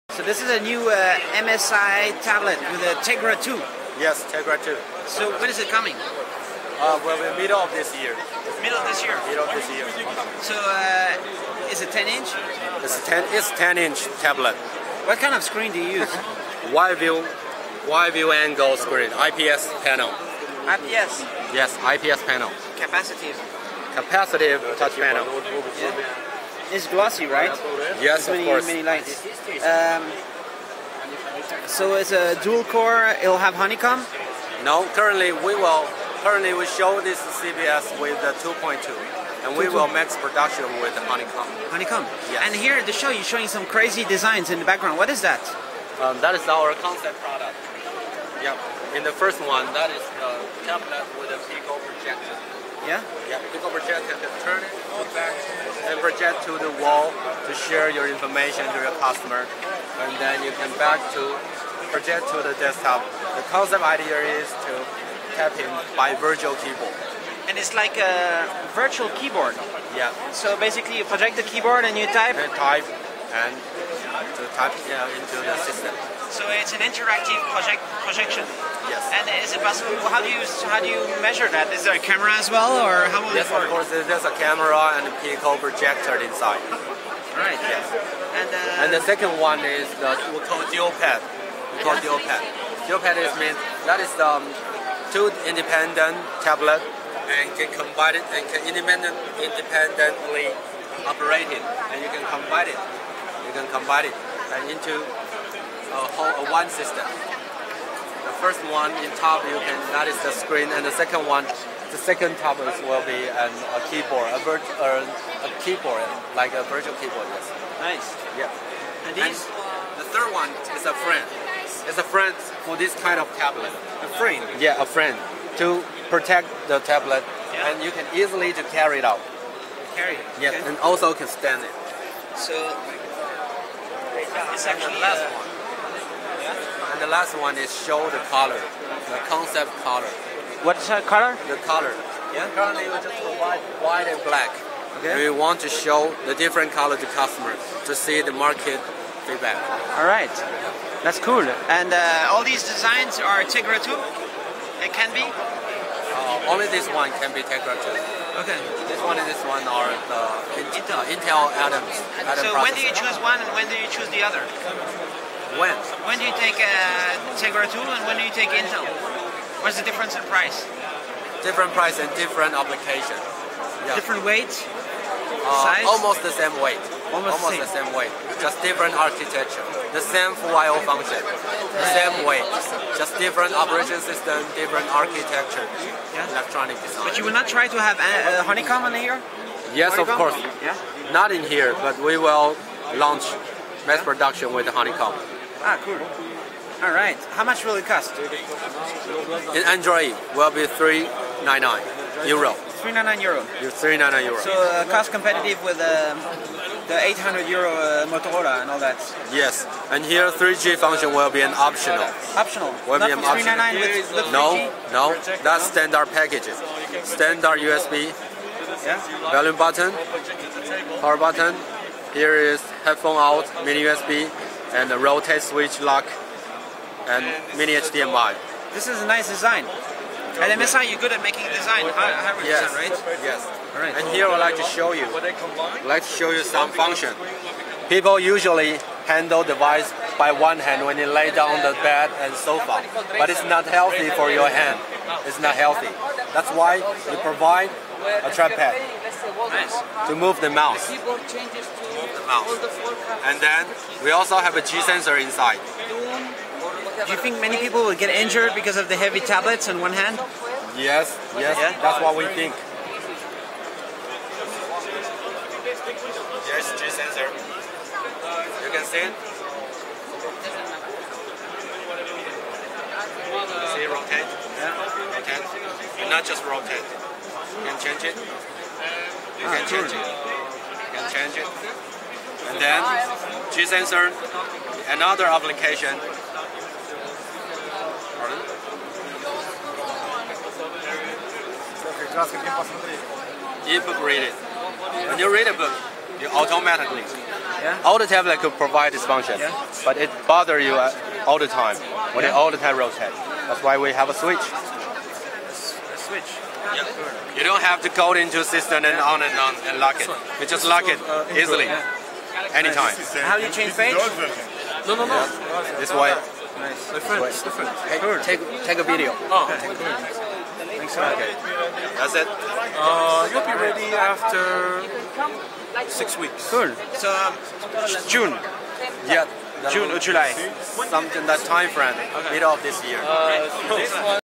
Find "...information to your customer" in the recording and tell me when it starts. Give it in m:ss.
0:58.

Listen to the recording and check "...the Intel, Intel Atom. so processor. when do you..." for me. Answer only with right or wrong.
right.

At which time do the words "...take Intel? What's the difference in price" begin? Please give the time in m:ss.
2:48.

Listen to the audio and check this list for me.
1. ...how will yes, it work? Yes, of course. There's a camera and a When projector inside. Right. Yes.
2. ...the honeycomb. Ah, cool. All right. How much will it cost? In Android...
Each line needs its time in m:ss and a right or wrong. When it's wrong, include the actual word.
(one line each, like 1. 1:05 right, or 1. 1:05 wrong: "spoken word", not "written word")
1. 1:23 wrong: "Pico", not "When"
2. 3:14 right.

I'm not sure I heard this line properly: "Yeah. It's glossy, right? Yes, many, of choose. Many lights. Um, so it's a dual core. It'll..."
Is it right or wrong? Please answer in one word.
wrong.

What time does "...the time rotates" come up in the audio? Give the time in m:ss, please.
5:02.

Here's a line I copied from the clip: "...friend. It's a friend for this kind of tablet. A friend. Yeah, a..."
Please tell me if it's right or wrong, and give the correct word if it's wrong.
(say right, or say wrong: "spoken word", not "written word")
right.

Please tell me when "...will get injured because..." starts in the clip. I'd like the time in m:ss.
4:17.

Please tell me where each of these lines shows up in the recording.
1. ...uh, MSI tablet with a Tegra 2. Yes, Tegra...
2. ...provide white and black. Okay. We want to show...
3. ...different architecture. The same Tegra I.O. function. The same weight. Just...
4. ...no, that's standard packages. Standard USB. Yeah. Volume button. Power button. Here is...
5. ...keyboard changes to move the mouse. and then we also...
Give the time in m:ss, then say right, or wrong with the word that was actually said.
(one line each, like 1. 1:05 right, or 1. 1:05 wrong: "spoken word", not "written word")
1. 0:00 right
2. 2:23 right
3. 2:58 wrong: "FIO", not "Tegra"
4. 3:34 right
5. 4:10 right.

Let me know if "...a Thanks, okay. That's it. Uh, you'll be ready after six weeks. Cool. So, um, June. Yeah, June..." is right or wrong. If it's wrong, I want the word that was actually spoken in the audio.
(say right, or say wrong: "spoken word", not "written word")
right.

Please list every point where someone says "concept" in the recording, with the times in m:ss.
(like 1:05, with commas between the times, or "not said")
0:46, 1:03, 2:19.